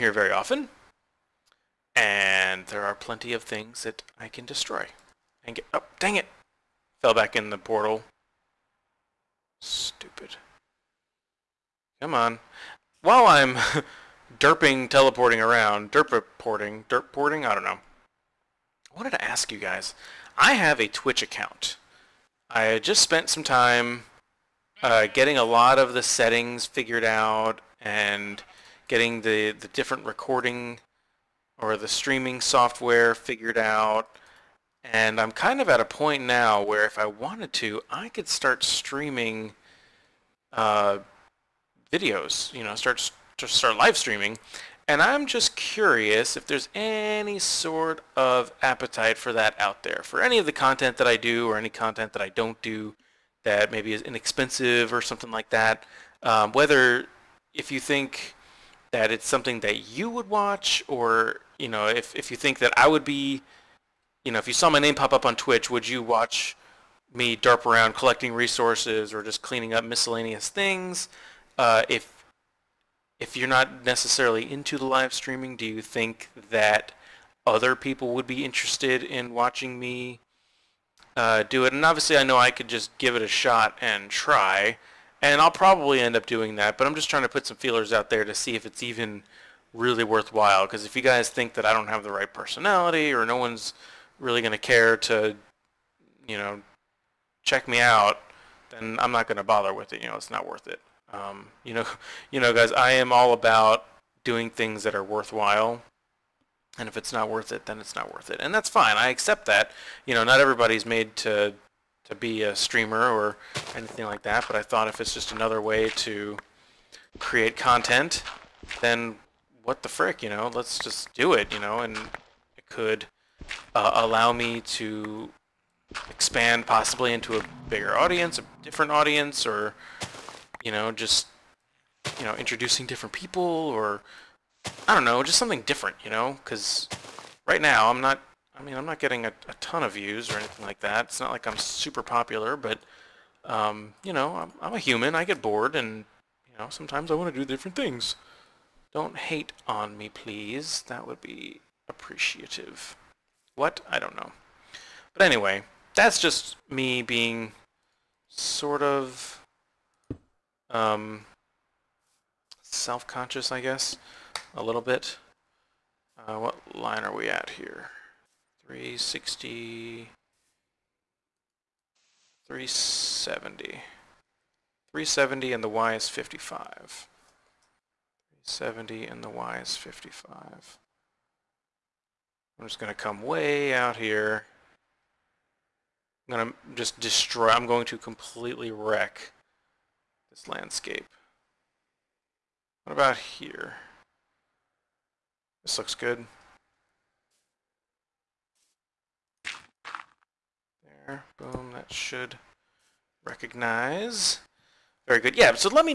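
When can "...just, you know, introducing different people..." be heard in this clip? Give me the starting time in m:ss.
2:10.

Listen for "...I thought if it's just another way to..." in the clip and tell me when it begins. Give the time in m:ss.
1:54.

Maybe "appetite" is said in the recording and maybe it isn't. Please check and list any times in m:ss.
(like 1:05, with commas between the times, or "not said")
0:48.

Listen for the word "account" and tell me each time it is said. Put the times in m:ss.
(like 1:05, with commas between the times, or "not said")
0:21.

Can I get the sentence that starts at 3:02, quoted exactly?
I'm just going to come way out here.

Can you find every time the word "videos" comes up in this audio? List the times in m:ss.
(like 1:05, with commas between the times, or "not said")
0:41.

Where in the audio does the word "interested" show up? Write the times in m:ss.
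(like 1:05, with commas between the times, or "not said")
1:18.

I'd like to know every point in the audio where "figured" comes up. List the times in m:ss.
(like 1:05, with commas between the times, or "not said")
0:26, 0:33.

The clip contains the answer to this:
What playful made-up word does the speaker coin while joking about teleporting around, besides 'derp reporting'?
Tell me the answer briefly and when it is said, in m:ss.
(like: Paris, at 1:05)
derp porting, at 0:16.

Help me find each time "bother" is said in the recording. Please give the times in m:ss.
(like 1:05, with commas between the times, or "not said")
1:39.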